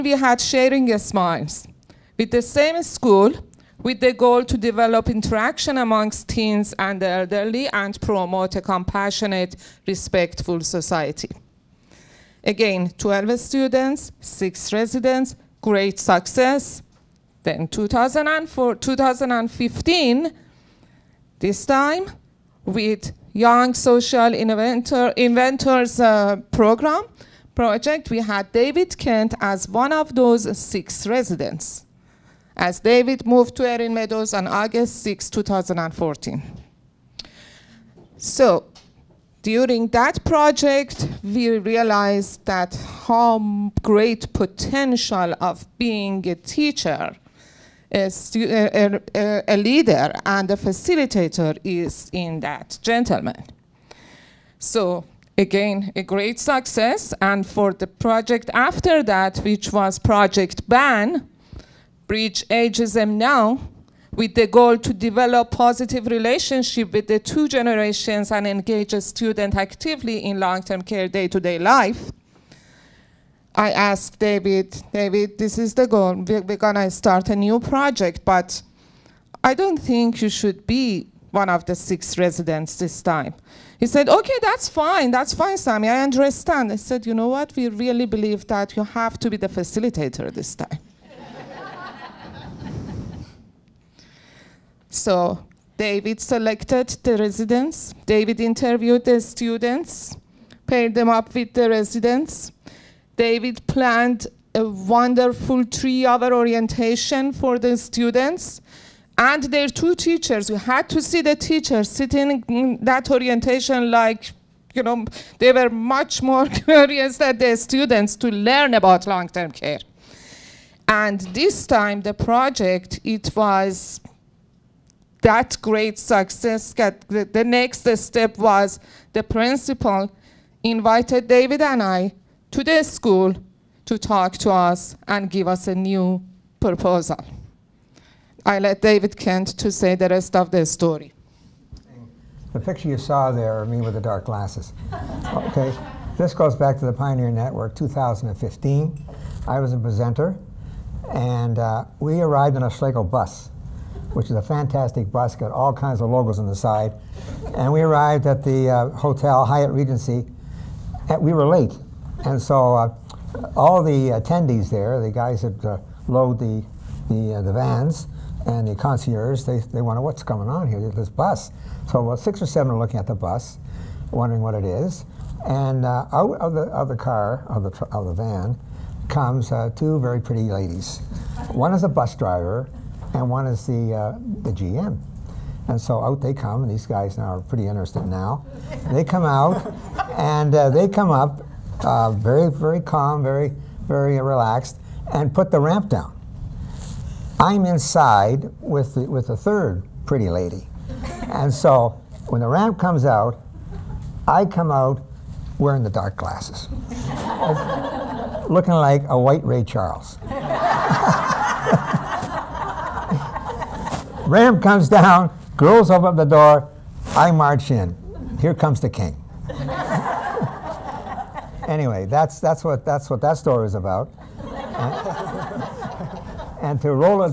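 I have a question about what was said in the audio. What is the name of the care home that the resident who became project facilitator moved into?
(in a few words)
Erin Meadows.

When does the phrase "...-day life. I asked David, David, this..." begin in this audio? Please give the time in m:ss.
1:11.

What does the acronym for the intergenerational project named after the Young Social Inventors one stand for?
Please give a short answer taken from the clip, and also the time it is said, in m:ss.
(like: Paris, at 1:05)
Breach Ageism Now, at 1:02.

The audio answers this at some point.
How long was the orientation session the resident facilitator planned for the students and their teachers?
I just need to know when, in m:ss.
1:45.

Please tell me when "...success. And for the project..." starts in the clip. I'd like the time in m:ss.
0:56.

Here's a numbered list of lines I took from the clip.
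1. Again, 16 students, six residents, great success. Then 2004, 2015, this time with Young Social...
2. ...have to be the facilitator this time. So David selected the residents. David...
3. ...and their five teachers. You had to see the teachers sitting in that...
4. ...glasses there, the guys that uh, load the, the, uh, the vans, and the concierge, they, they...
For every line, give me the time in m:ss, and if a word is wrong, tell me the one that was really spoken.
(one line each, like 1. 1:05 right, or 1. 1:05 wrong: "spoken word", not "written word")
1. 0:12 wrong: "12", not "16"
2. 1:28 right
3. 1:49 wrong: "two", not "five"
4. 2:44 wrong: "attendees", not "glasses".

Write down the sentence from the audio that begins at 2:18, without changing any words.
I let David Kent to say the rest of the story.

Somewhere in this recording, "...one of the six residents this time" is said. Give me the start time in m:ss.
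1:21.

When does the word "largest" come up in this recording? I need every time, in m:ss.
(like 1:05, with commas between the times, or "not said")
not said.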